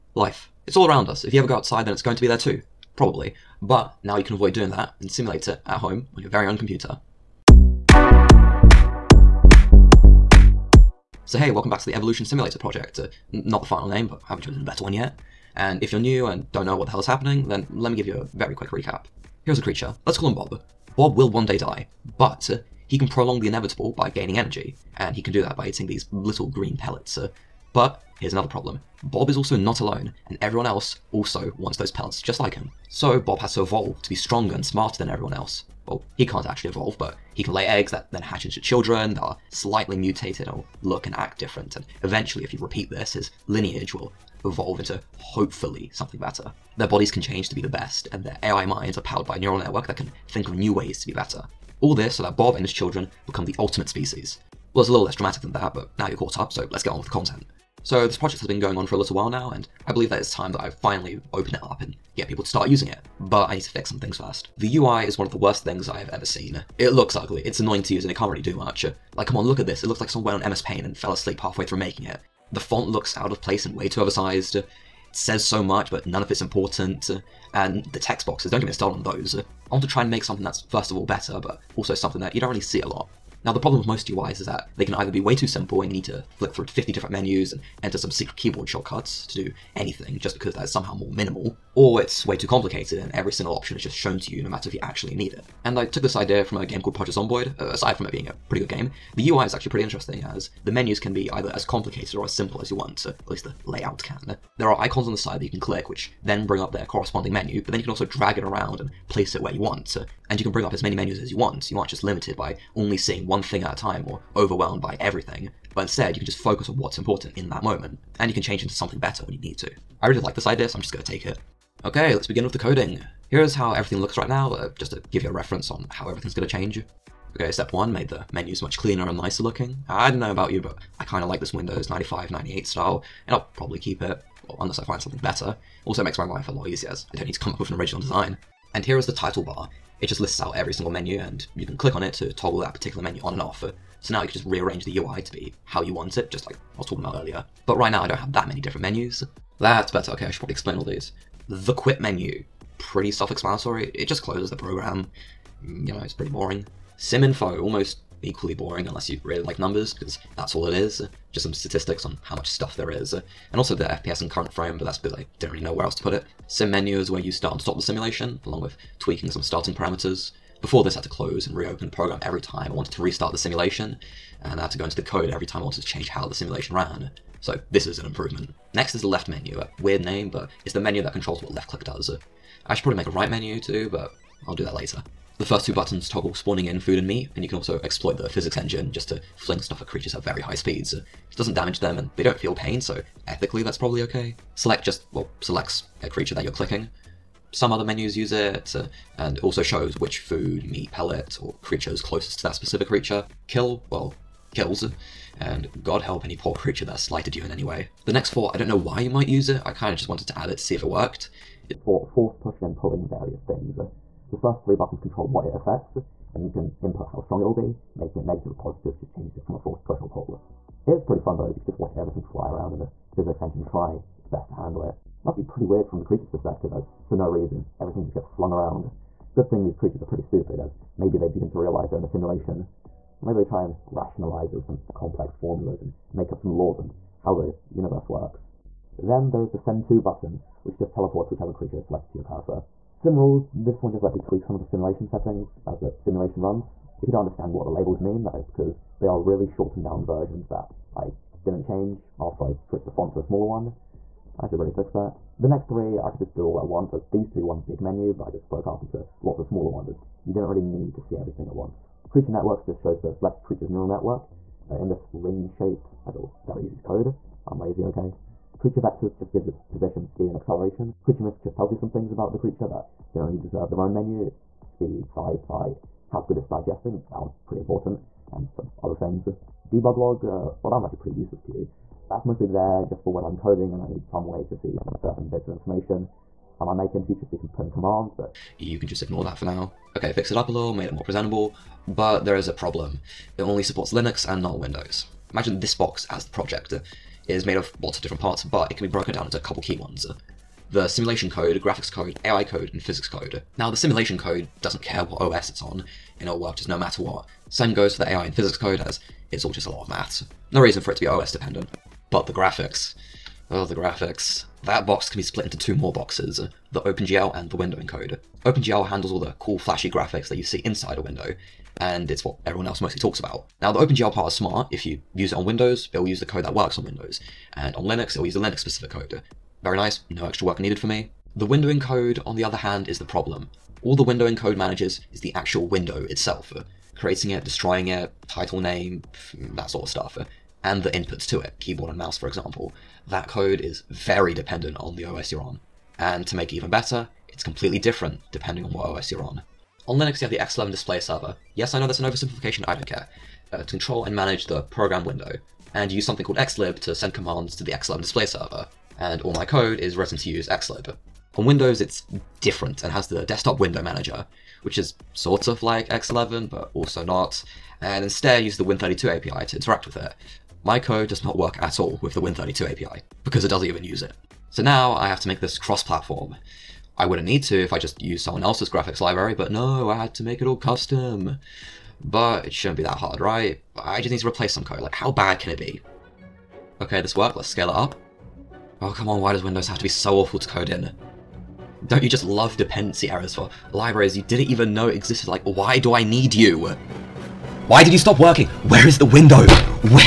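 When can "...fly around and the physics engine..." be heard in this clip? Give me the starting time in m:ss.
3:42.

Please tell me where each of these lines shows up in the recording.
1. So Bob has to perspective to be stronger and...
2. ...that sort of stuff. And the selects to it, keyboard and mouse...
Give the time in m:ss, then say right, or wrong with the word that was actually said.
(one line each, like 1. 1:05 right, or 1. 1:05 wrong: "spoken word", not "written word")
1. 0:32 wrong: "evolve", not "perspective"
2. 5:39 wrong: "inputs", not "selects".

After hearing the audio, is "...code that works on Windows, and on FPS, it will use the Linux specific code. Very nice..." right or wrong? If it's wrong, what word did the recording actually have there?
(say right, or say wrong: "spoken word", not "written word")
wrong: "Linux", not "FPS".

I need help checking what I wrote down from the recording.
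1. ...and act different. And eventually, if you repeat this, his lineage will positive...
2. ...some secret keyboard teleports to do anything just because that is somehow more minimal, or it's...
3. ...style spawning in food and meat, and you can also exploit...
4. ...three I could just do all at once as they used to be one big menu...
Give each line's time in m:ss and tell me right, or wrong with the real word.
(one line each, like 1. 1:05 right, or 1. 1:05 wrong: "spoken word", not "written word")
1. 0:41 wrong: "evolve", not "positive"
2. 1:27 wrong: "shortcuts", not "teleports"
3. 3:06 wrong: "toggle", not "style"
4. 4:15 right.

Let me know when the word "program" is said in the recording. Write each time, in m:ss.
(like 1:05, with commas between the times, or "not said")
2:34, 2:51, 5:54.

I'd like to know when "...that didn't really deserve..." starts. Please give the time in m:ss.
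4:32.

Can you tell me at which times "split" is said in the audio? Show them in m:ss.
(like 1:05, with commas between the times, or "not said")
5:15.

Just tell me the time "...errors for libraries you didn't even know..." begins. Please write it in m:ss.
6:33.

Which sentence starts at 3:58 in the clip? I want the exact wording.
Then there is the send to button, which just teleports whichever creature is selected to your cursor.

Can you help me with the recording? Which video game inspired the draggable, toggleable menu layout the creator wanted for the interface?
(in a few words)
Project Zomboid.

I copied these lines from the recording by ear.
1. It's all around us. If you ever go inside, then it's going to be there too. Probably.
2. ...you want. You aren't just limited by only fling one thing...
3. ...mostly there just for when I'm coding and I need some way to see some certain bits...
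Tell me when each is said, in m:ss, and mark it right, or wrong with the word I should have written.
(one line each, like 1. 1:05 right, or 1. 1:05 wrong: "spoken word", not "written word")
1. 0:00 wrong: "outside", not "inside"
2. 1:51 wrong: "seeing", not "fling"
3. 4:42 right.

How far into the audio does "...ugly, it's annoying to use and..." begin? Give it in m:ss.
1:07.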